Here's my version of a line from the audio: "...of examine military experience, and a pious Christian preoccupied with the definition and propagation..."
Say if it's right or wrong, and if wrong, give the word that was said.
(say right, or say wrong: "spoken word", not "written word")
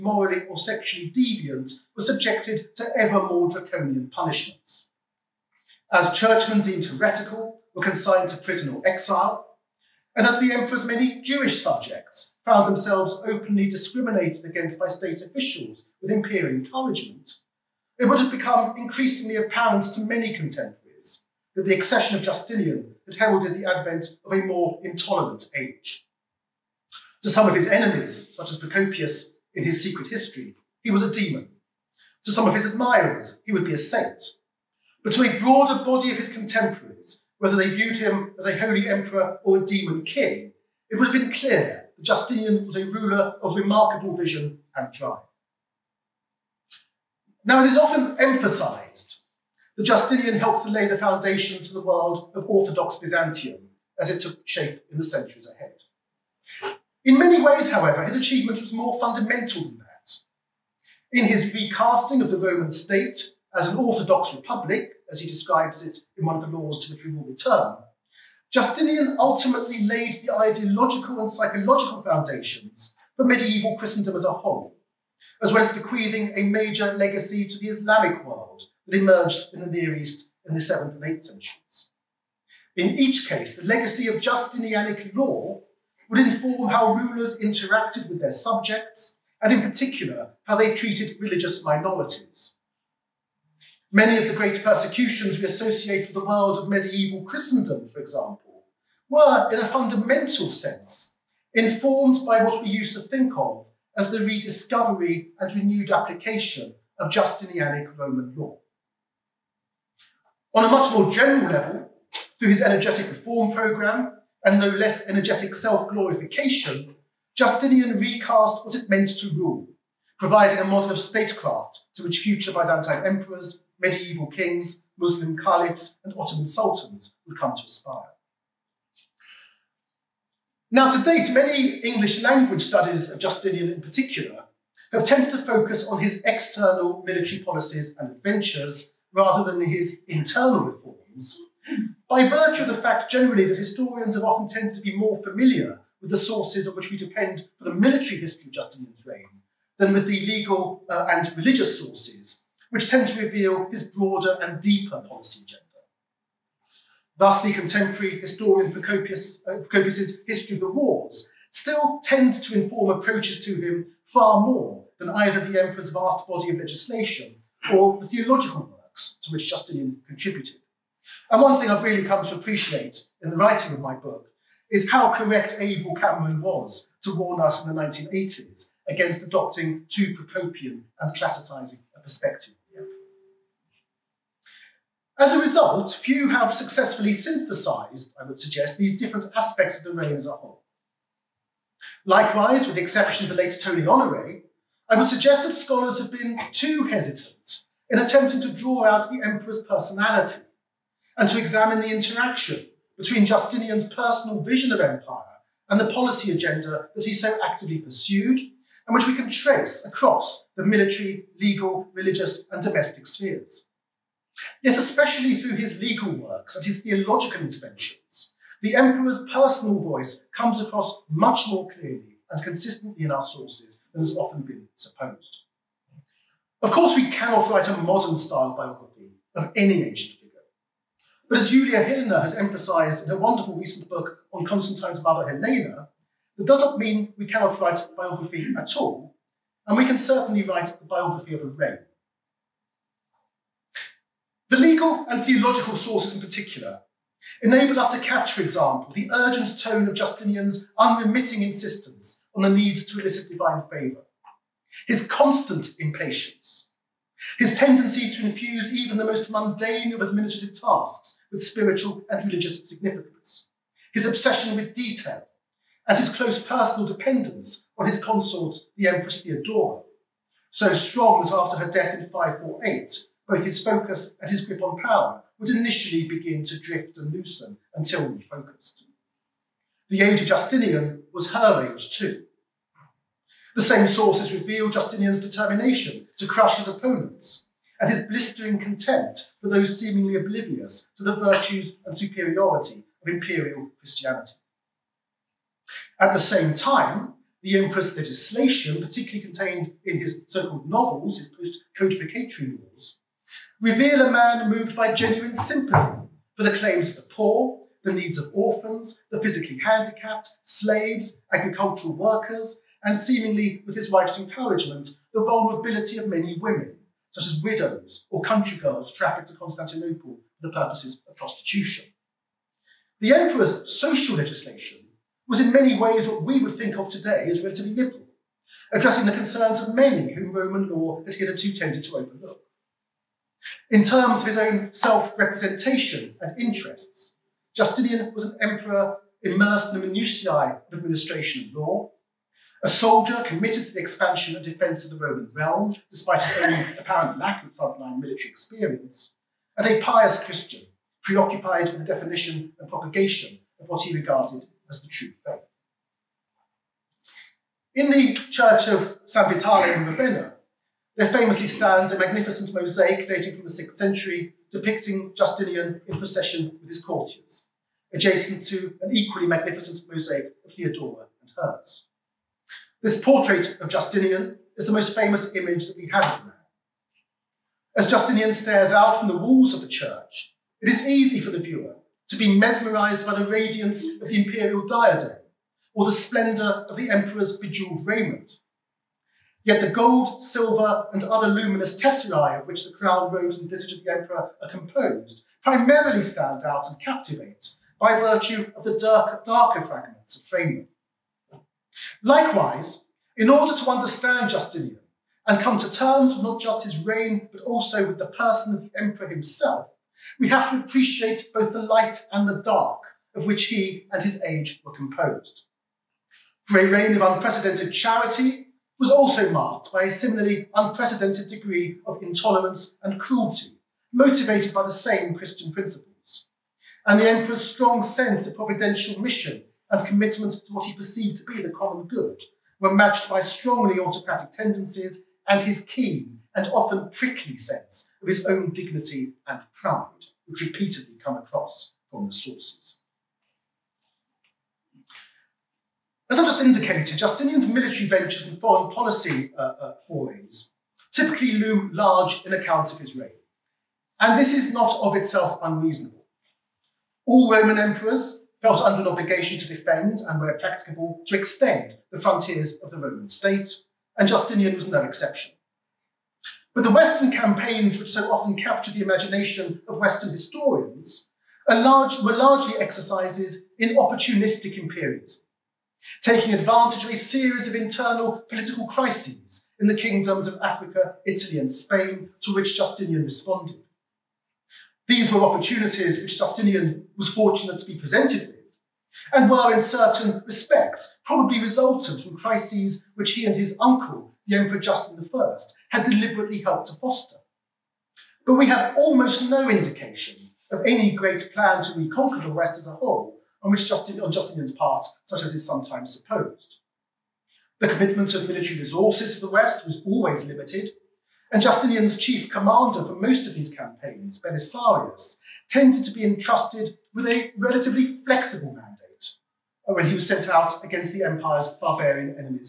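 wrong: "frontline", not "examine".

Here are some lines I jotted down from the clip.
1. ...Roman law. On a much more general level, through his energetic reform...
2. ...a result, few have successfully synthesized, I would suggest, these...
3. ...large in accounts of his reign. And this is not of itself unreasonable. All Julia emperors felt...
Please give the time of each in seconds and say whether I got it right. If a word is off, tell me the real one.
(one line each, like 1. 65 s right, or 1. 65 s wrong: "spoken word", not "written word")
1. 107 s right
2. 185 s right
3. 451 s wrong: "Roman", not "Julia".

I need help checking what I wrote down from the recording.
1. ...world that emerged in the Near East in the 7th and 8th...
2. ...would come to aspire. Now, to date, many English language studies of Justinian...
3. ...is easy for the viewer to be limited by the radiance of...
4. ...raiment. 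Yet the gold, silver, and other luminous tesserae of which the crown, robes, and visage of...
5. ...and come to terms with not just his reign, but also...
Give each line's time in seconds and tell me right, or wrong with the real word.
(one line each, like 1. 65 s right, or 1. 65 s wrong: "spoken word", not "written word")
1. 78 s right
2. 127 s right
3. 380 s wrong: "mesmerized", not "limited"
4. 387 s right
5. 405 s right.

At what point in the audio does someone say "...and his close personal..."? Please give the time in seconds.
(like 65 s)
265 s.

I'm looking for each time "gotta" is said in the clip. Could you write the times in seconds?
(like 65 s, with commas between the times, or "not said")
not said.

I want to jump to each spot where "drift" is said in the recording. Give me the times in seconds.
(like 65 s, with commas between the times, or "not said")
276 s.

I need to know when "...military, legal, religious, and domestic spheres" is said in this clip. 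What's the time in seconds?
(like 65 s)
210 s.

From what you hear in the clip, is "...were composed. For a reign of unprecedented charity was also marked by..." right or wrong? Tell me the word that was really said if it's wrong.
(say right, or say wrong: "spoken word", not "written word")
right.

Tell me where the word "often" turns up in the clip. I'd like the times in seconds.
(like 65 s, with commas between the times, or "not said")
47 s, 144 s, 224 s, 436 s, 468 s.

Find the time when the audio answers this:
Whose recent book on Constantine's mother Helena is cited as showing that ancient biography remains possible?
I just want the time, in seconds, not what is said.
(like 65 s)
231 s.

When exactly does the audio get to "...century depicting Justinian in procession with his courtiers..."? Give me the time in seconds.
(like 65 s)
363 s.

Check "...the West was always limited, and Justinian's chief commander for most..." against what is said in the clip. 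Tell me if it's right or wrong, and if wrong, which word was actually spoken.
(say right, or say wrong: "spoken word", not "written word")
right.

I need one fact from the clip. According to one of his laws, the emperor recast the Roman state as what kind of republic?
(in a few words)
Orthodox republic.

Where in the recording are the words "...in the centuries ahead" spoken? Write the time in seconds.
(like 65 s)
54 s.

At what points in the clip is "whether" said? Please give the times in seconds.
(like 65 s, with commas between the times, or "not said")
37 s.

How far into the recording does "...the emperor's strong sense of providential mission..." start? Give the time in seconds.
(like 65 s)
426 s.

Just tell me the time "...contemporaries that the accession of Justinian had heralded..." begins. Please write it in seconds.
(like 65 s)
20 s.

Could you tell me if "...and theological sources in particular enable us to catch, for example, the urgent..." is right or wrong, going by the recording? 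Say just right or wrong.
right.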